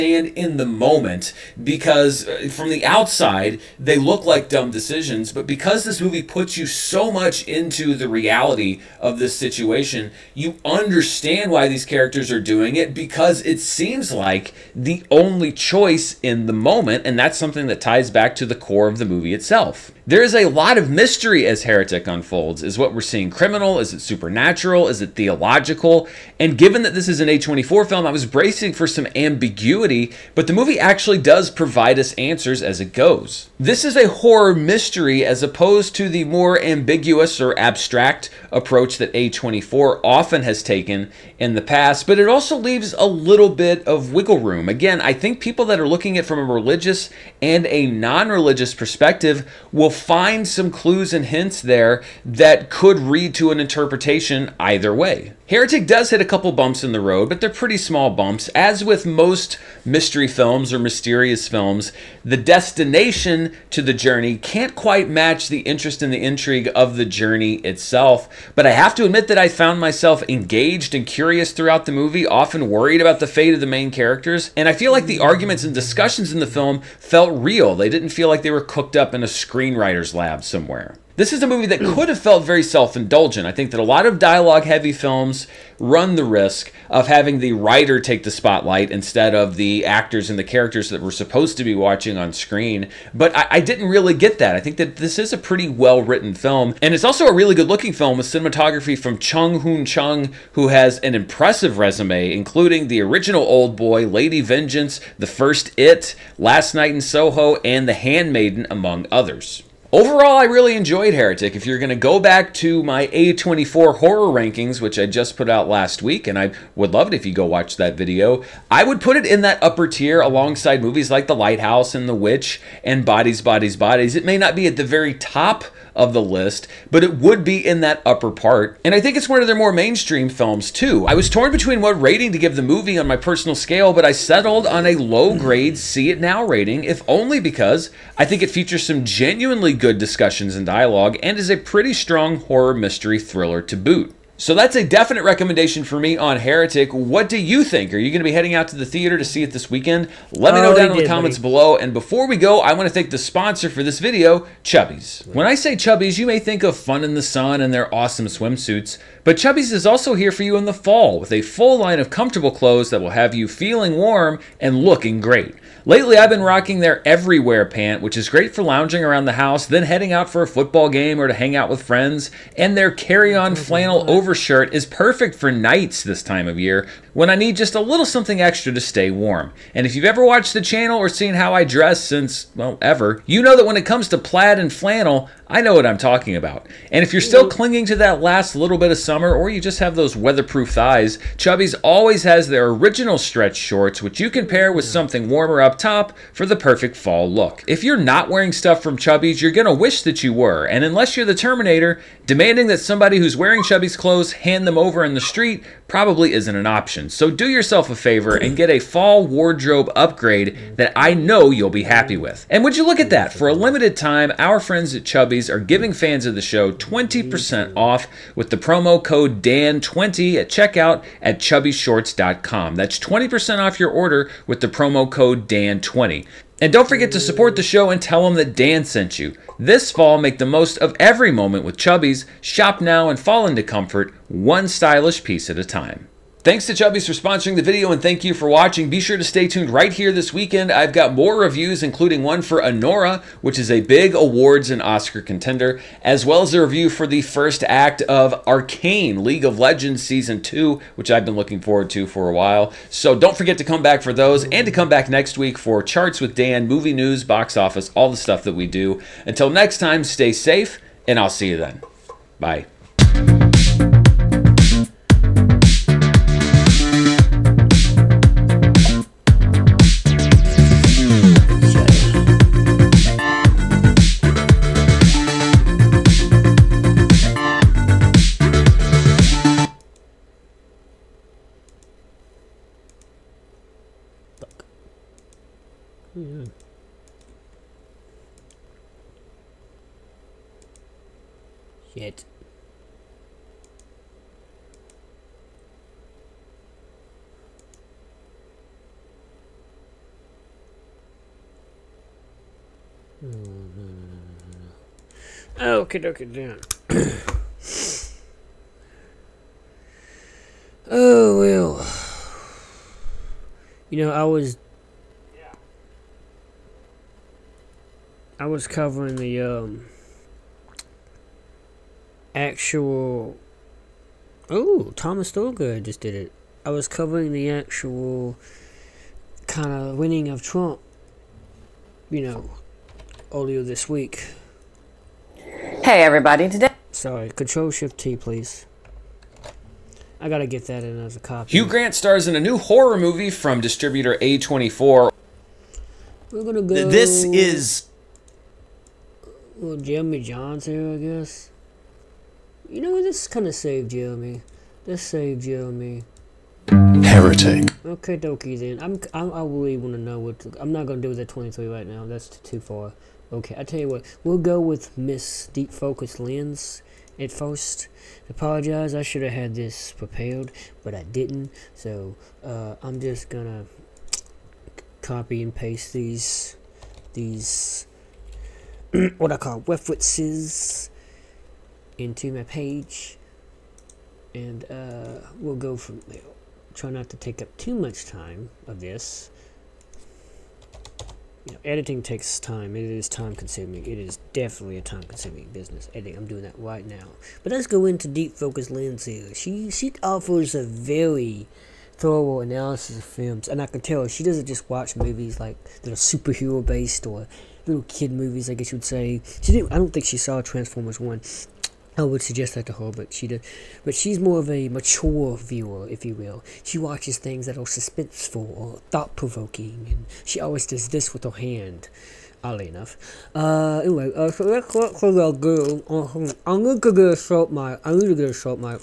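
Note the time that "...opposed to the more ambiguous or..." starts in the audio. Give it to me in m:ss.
0:35.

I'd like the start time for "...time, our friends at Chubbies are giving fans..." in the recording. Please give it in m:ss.
3:33.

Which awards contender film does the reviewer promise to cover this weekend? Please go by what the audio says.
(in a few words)
Anora.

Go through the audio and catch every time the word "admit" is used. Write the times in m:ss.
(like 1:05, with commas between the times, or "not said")
1:09.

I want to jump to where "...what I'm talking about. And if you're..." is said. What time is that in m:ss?
3:05.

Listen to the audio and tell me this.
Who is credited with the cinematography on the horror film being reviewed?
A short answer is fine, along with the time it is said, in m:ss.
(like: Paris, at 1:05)
Chung Hoon Chung, at 1:39.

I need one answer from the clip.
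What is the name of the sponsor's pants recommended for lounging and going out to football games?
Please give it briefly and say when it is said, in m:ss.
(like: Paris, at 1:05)
everywhere pant, at 2:47.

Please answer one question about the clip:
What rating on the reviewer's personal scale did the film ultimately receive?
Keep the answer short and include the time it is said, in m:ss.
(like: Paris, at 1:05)
See It Now, at 2:15.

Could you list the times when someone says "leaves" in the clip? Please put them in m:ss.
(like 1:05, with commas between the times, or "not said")
0:42.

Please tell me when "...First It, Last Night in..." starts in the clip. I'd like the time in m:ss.
1:45.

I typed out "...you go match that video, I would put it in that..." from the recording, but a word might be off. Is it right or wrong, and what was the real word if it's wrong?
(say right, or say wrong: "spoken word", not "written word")
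wrong: "watch", not "match".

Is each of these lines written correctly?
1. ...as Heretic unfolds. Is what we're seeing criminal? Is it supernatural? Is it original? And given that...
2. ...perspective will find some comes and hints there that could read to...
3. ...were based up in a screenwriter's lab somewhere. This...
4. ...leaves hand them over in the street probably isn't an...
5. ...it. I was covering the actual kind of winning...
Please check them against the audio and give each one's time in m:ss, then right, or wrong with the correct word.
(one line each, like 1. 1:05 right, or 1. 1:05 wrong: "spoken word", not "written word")
1. 0:21 wrong: "theological", not "original"
2. 0:48 wrong: "clues", not "comes"
3. 1:18 wrong: "cooked", not "based"
4. 3:23 wrong: "clothes", not "leaves"
5. 5:26 right.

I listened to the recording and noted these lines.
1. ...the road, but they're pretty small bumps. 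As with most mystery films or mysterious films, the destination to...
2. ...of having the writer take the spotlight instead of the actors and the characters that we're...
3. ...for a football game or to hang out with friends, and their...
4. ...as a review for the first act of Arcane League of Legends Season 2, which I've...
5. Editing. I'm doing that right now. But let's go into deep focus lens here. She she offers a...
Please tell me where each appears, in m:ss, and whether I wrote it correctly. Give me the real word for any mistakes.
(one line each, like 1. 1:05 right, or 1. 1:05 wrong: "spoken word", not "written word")
1. 0:56 right
2. 1:26 right
3. 2:50 right
4. 4:06 right
5. 6:35 right.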